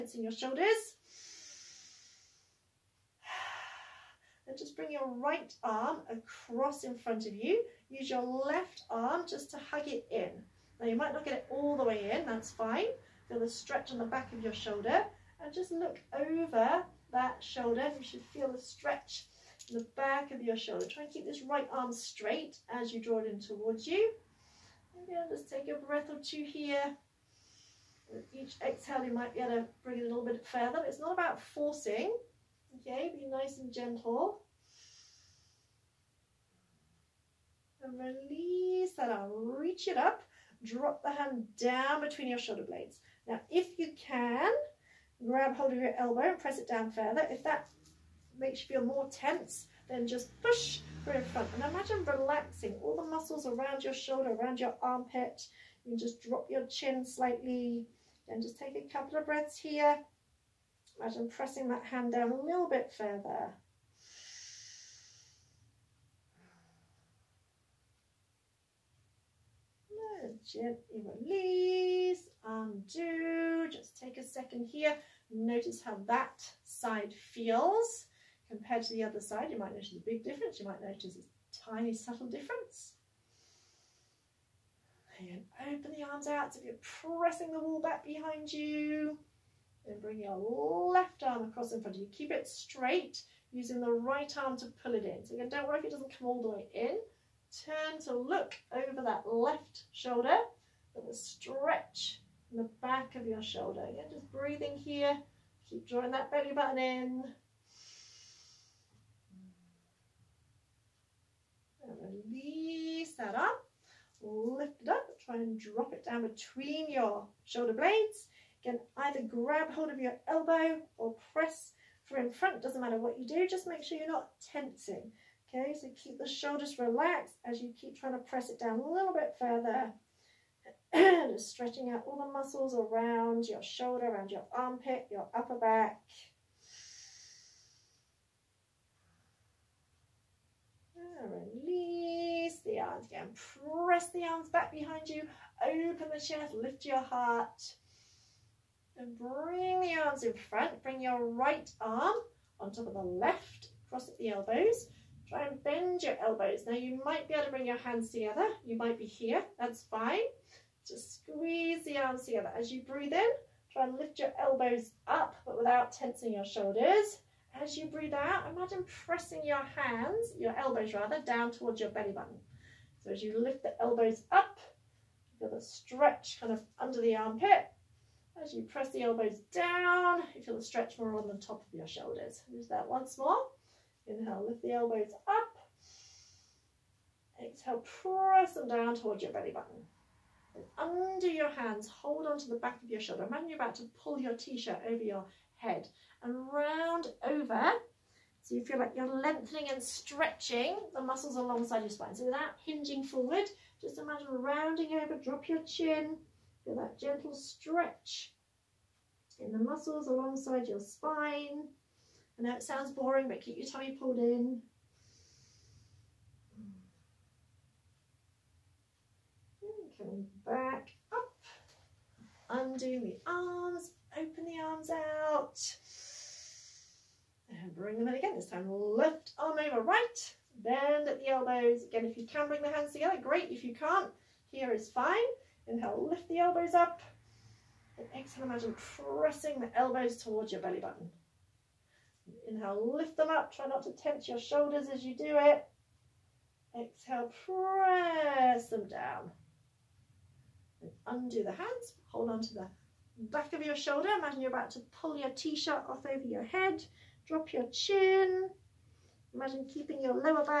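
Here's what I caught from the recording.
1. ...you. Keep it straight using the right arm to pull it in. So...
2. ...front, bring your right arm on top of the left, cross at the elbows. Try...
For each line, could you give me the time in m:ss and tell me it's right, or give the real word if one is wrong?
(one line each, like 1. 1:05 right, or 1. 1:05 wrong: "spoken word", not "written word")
1. 1:32 right
2. 2:30 right.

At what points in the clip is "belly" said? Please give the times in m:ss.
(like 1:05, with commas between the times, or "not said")
1:46, 2:51, 3:09, 4:00.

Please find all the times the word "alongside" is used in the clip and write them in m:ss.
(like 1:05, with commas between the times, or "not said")
3:21, 3:30.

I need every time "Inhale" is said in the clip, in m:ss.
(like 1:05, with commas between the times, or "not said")
3:04, 3:55, 4:02.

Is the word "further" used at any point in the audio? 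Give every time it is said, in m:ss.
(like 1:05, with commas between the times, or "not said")
0:30, 0:46, 1:02, 2:09.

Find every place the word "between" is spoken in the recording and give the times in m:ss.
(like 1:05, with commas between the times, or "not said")
0:42, 1:56.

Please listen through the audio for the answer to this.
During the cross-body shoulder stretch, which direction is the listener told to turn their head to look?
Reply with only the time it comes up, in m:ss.
0:15.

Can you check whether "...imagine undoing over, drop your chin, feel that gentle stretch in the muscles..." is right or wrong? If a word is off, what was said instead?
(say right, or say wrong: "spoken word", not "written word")
wrong: "rounding", not "undoing".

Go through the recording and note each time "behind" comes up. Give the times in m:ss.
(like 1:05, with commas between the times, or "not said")
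1:28, 2:24.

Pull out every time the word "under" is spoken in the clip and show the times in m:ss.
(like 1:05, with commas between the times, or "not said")
2:56, 3:10.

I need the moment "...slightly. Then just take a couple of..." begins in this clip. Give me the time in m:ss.
0:57.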